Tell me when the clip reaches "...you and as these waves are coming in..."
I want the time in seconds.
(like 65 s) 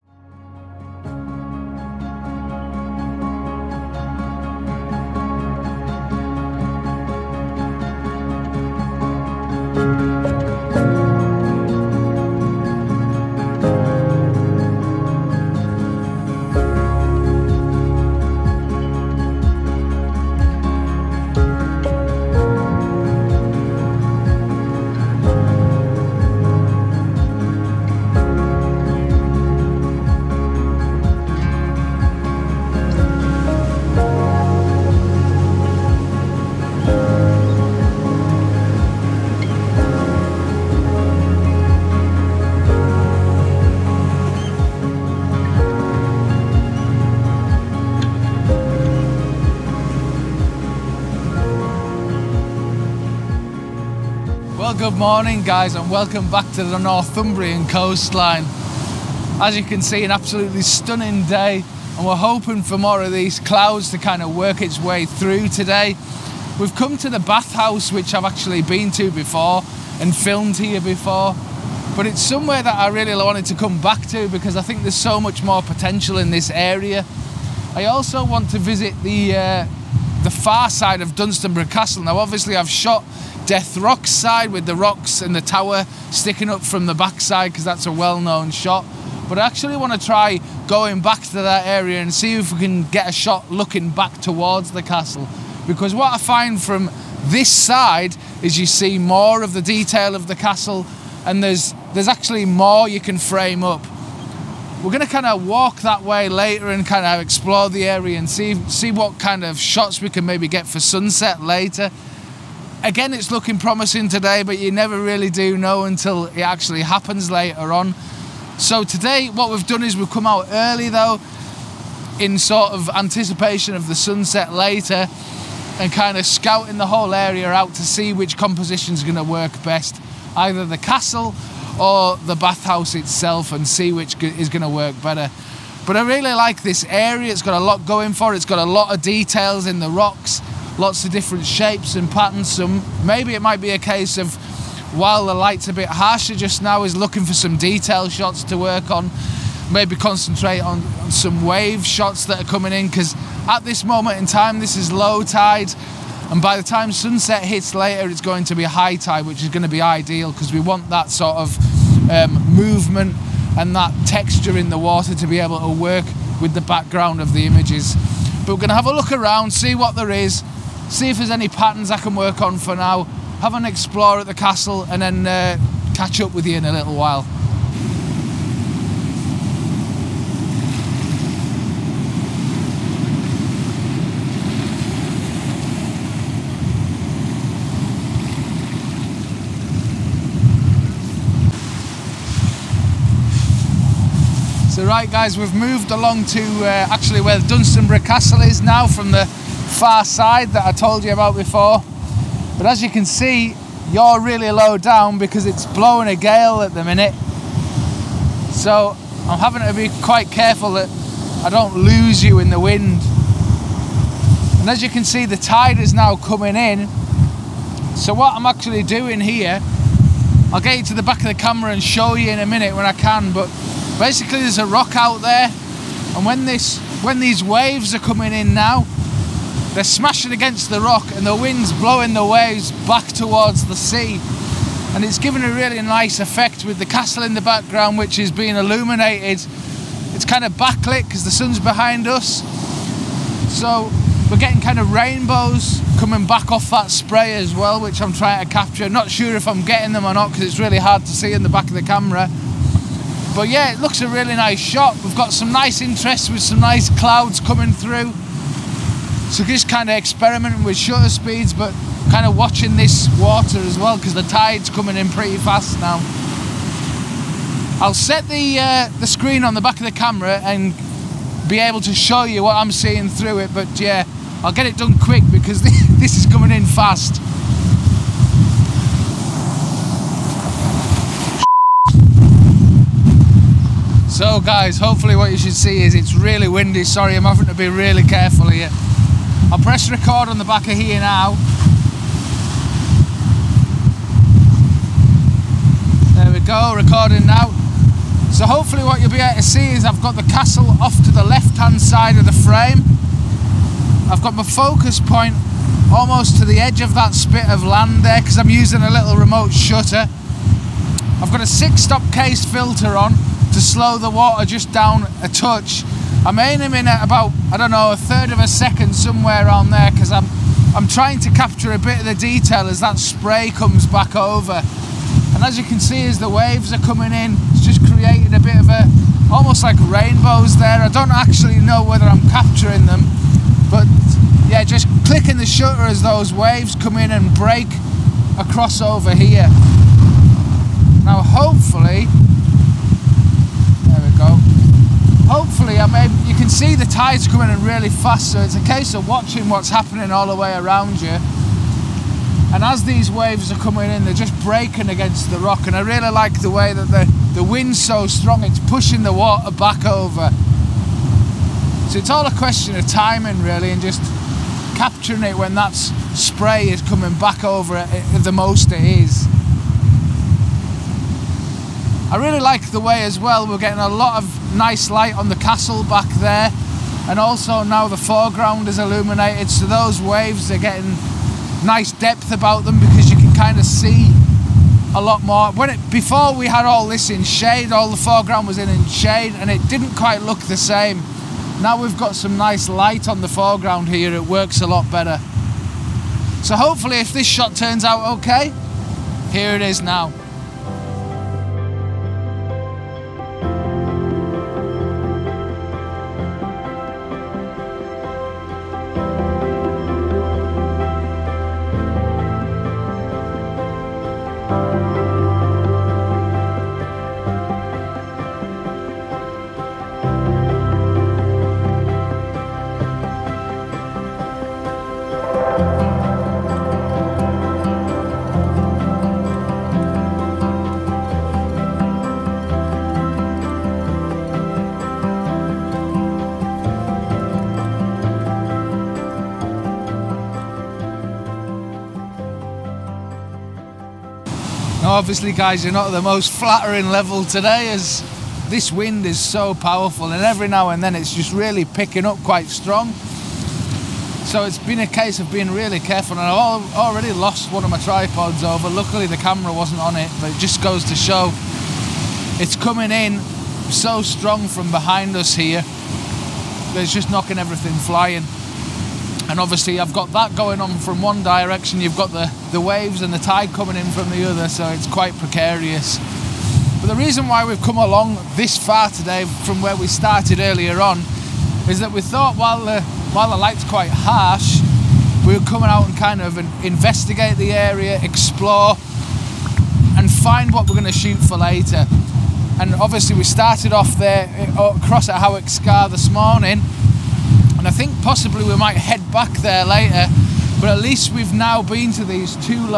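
351 s.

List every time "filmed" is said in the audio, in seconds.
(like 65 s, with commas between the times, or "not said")
70 s.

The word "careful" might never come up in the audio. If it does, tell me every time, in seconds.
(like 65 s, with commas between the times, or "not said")
210 s, 288 s, 455 s.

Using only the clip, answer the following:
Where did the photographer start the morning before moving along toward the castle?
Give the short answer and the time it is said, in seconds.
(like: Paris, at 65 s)
Howick Scar, at 495 s.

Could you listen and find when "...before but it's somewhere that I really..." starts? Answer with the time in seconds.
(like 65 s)
70 s.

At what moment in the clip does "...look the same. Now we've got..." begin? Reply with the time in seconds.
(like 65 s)
390 s.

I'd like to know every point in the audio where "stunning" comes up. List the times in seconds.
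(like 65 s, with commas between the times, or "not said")
60 s.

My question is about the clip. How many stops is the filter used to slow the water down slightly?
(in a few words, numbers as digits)
6.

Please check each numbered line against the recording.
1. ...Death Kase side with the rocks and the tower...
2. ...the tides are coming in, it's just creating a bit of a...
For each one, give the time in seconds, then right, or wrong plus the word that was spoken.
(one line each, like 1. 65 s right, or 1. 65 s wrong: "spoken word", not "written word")
1. 83 s wrong: "Rock", not "Kase"
2. 326 s wrong: "waves", not "tides".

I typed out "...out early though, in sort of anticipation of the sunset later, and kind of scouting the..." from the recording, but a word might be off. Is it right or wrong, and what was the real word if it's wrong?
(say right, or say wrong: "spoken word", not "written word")
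right.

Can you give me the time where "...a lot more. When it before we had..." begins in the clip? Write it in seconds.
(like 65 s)
384 s.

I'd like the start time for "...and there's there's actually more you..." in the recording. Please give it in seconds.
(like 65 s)
101 s.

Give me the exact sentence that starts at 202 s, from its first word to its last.
But as you can see, you're really low down because it's blowing a gale at the minute.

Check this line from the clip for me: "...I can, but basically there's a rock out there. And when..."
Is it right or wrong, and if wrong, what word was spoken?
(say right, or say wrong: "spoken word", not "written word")
right.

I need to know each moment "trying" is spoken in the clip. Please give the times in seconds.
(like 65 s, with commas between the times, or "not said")
248 s, 320 s.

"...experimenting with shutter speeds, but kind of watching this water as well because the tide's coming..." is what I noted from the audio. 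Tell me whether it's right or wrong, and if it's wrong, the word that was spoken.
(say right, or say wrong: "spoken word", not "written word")
right.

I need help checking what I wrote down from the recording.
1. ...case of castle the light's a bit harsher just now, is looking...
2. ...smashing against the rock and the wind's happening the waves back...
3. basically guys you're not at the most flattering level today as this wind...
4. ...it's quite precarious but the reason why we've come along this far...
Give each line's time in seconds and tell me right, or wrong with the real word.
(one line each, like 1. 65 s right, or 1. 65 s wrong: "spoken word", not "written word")
1. 143 s wrong: "while", not "castle"
2. 229 s wrong: "blowing", not "happening"
3. 444 s wrong: "obviously", not "basically"
4. 474 s right.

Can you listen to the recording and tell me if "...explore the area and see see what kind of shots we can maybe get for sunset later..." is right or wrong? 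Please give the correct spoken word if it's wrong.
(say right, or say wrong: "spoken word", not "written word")
right.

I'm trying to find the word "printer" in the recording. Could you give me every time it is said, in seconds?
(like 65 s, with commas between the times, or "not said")
not said.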